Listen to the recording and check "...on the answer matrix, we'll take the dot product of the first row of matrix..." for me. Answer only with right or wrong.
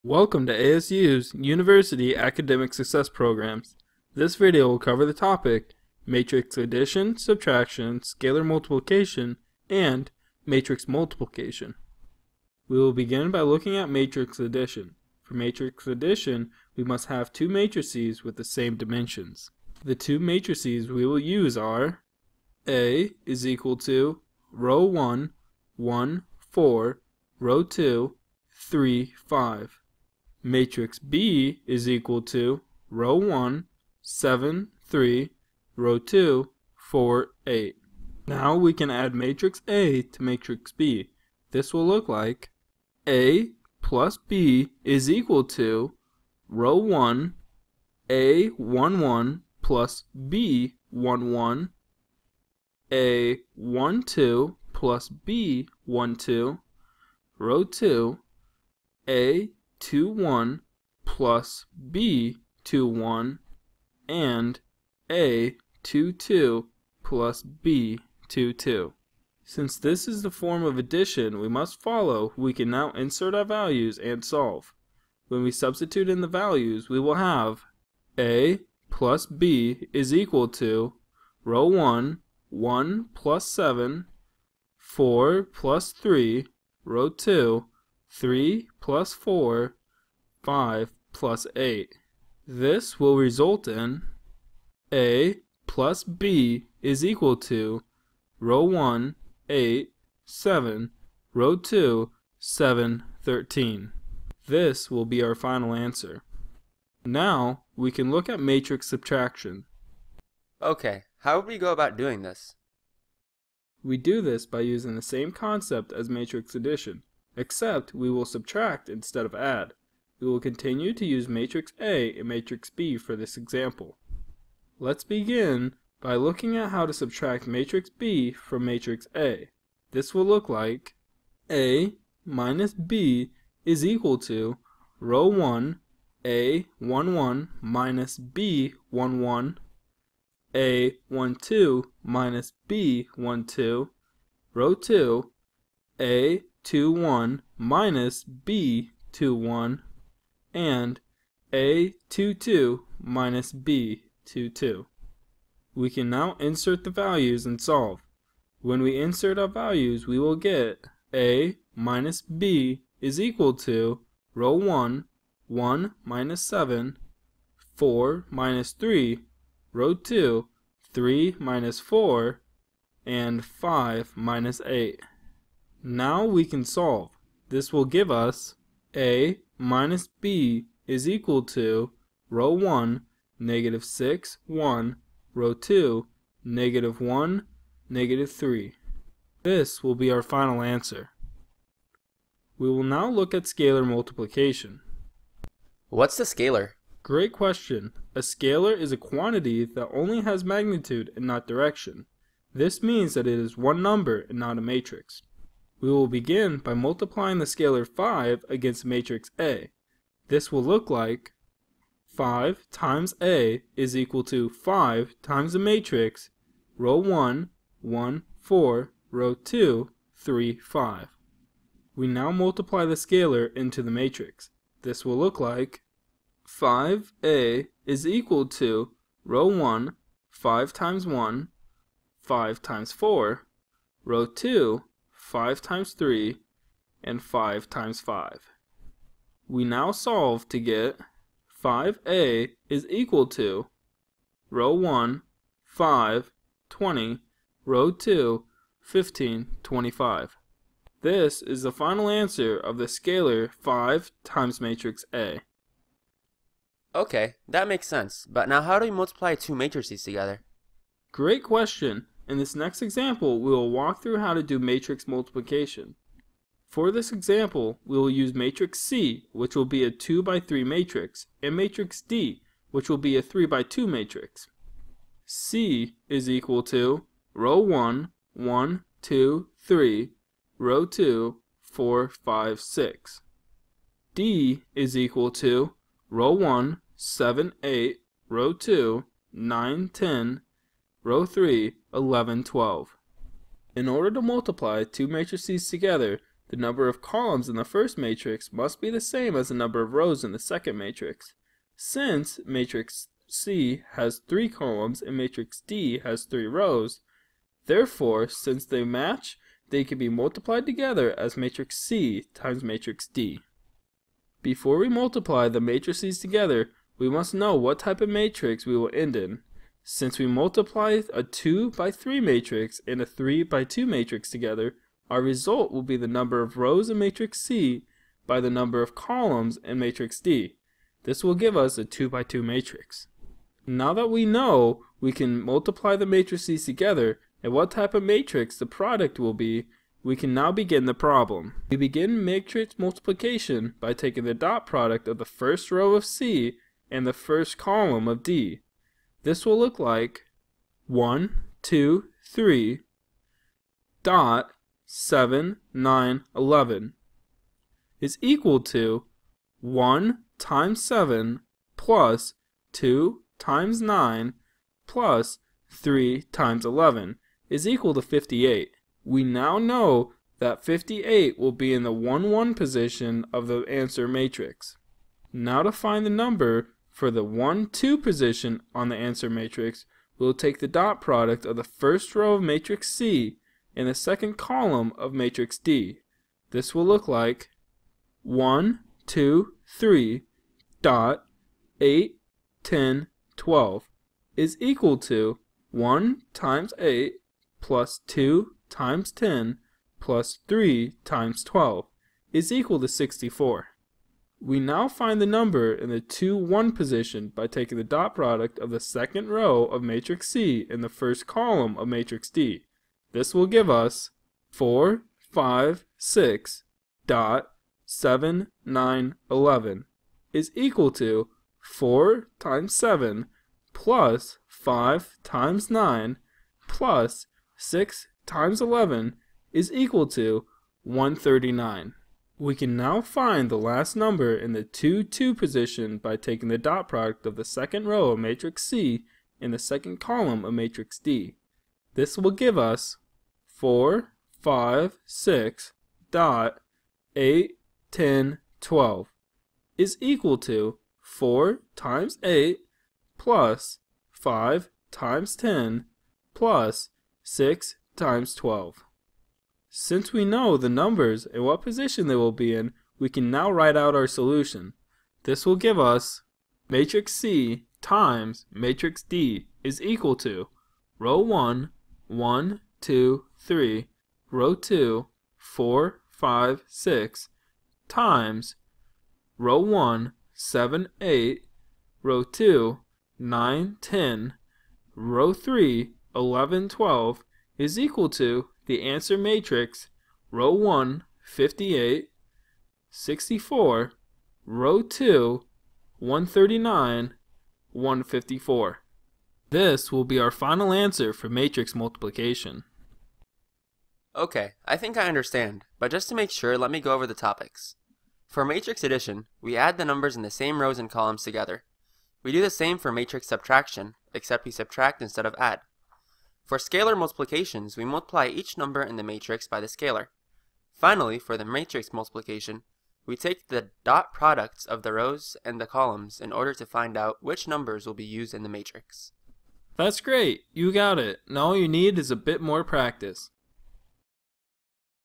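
right.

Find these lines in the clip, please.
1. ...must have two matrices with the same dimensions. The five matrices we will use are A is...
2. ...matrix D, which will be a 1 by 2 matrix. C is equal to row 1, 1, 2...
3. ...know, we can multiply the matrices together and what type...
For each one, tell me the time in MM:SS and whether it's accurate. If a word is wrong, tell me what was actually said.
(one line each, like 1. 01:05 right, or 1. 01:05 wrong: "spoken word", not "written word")
1. 00:16 wrong: "two", not "five"
2. 04:31 wrong: "3", not "1"
3. 05:34 right.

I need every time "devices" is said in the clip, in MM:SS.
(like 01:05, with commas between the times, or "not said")
not said.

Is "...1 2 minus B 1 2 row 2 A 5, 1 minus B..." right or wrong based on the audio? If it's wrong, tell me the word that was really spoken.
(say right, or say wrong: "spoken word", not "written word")
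wrong: "2", not "5".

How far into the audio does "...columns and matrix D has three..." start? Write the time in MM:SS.
05:04.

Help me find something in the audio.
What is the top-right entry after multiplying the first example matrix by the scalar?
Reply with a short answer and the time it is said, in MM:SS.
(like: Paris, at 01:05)
20, at 04:06.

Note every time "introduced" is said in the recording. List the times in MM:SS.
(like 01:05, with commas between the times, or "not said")
not said.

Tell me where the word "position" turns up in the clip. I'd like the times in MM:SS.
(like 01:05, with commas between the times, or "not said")
06:12, 06:17, 06:46, 07:15, 07:41.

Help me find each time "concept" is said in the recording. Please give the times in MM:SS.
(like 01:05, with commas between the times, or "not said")
01:55.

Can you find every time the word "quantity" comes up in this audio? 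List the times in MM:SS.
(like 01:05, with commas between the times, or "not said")
03:18.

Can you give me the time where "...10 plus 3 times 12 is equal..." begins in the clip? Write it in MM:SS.
06:39.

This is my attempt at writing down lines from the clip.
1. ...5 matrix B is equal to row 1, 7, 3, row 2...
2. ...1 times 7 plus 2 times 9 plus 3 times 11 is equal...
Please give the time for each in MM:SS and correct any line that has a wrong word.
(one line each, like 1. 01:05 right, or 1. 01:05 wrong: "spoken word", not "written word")
1. 00:29 right
2. 05:59 right.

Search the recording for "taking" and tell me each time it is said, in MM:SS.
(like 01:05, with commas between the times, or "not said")
05:43, 06:47, 07:16.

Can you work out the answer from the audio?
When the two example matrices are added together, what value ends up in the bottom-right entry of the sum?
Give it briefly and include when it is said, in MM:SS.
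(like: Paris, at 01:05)
13, at 01:43.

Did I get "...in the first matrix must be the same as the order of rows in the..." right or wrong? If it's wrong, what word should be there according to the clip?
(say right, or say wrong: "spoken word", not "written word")
wrong: "number", not "order".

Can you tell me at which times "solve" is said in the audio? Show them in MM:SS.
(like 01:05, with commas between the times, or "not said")
01:14, 02:37, 02:56, 03:59.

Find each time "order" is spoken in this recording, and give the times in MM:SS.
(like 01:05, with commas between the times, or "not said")
04:53, 08:46.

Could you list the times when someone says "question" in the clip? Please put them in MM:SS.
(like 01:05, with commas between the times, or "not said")
03:17, 04:21.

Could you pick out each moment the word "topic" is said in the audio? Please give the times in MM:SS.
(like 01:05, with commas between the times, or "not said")
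00:05, 08:27.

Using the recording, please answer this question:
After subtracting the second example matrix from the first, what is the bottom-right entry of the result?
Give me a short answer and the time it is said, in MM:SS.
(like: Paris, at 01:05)
-3, at 03:07.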